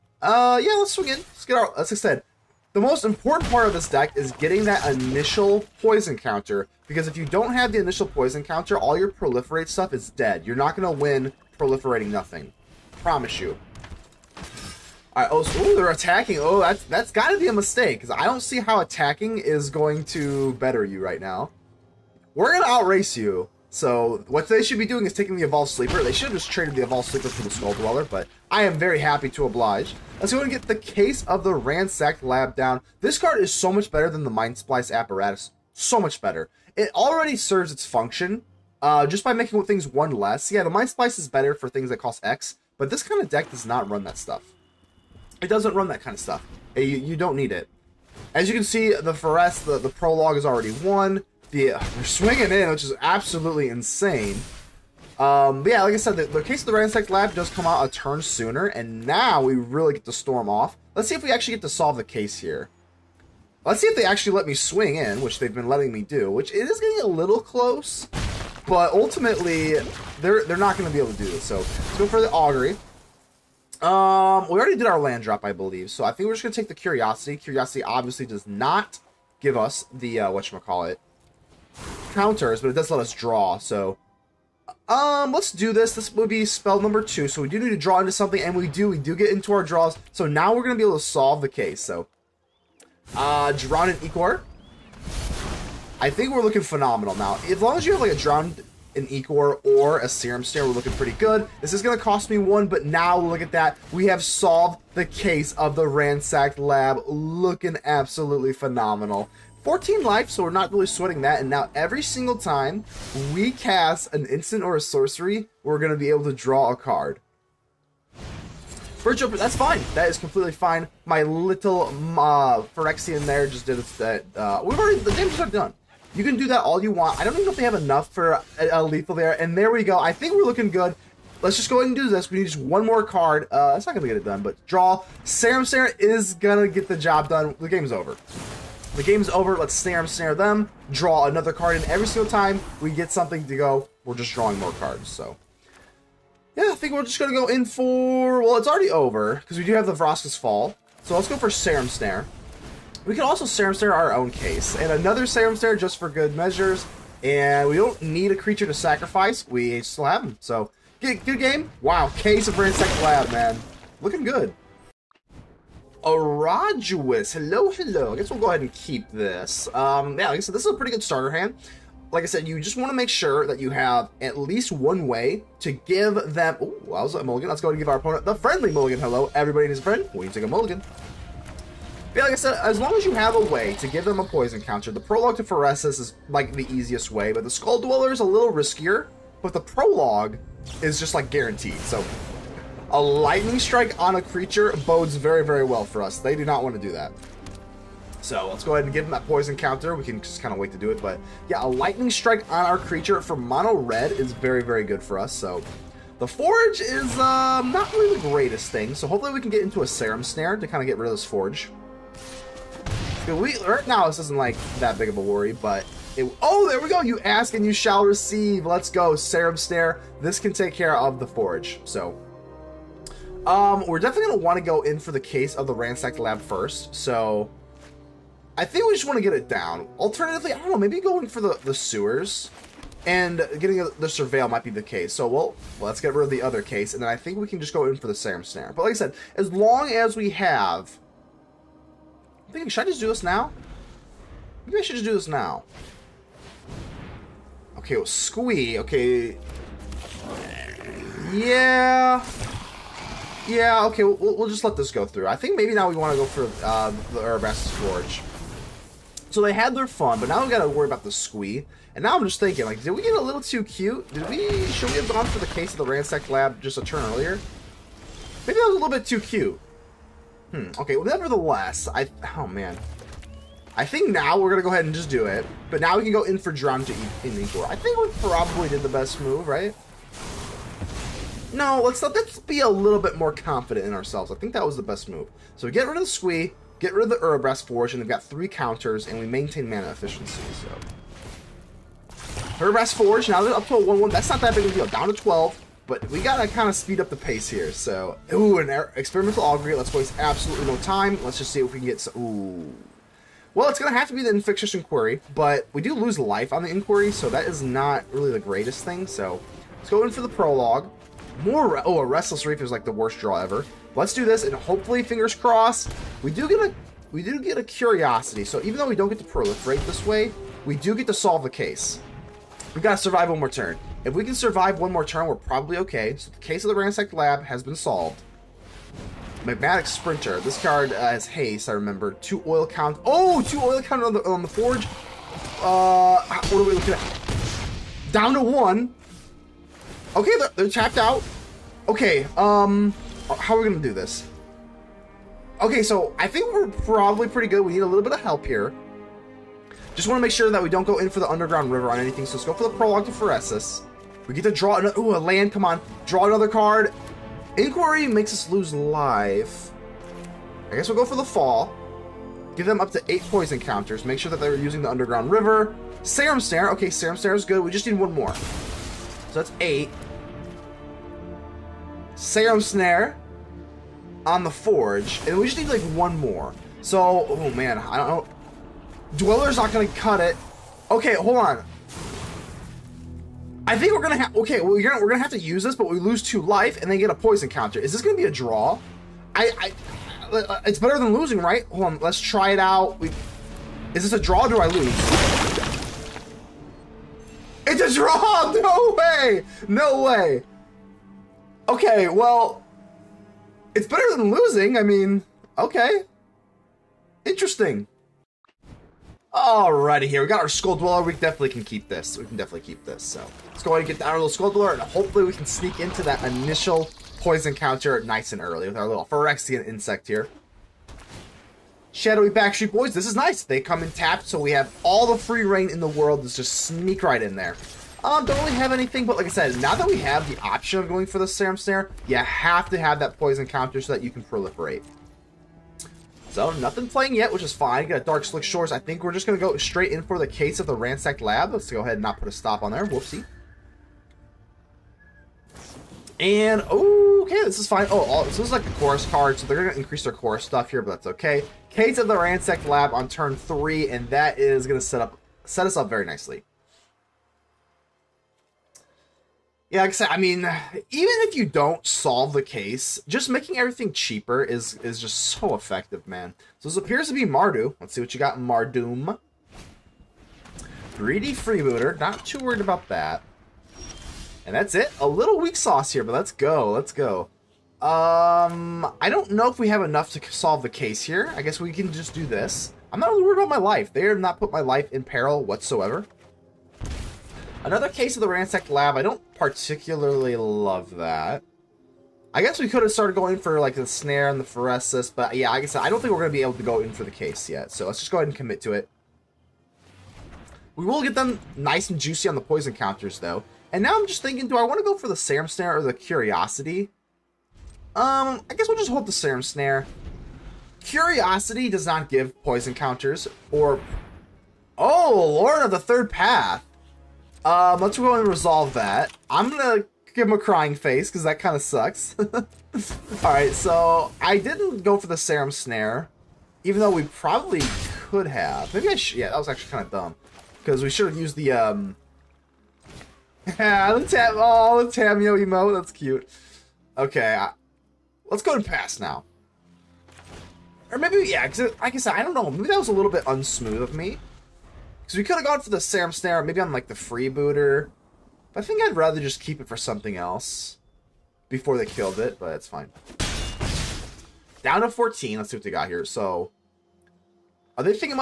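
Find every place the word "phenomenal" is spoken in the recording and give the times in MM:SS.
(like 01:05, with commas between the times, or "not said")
01:36, 01:48.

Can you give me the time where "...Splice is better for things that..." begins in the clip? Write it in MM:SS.
00:40.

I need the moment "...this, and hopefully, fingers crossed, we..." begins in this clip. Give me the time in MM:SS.
05:14.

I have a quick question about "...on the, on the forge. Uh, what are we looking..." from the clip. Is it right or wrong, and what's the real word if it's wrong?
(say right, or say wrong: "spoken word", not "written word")
right.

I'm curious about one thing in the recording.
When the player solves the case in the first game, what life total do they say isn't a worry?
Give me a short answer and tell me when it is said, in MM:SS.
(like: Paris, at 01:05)
14, at 01:49.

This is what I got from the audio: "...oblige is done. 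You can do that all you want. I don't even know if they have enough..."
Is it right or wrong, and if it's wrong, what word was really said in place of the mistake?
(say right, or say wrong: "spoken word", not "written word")
wrong: "damage", not "oblige".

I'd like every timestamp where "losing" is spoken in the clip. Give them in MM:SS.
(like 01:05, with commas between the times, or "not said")
06:31, 06:44.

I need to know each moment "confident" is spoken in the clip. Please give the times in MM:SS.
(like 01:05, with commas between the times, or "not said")
04:43.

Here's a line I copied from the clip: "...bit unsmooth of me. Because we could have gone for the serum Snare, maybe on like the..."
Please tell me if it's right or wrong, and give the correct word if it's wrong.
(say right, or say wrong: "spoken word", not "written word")
right.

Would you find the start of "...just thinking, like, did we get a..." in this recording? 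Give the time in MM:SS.
04:22.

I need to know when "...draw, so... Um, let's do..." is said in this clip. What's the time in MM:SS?
01:23.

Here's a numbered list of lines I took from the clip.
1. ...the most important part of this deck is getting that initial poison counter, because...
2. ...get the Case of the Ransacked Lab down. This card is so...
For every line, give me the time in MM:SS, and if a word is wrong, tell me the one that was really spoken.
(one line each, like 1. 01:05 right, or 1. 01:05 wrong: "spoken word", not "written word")
1. 00:02 right
2. 00:30 right.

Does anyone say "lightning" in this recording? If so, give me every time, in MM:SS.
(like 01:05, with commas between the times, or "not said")
03:13, 03:21.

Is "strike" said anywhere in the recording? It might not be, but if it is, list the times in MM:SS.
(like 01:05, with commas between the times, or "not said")
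03:13, 03:22.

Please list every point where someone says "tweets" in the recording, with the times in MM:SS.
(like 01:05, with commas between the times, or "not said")
not said.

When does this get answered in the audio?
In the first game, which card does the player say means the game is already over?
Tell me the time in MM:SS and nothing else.
02:29.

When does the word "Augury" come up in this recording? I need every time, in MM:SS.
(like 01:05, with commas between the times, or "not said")
01:12, 04:59.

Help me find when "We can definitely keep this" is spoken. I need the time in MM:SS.
06:52.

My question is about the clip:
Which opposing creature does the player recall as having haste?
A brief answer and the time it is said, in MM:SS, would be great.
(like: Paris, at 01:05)
Magmatic Sprinter, at 05:29.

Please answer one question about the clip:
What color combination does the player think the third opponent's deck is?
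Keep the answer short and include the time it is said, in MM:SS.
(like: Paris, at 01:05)
Mardu, at 07:47.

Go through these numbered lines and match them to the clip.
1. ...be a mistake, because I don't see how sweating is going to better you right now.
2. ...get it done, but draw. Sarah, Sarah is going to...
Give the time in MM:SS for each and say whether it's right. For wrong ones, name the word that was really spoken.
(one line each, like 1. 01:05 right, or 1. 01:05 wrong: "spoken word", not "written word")
1. 00:17 wrong: "attacking", not "sweating"
2. 02:14 right.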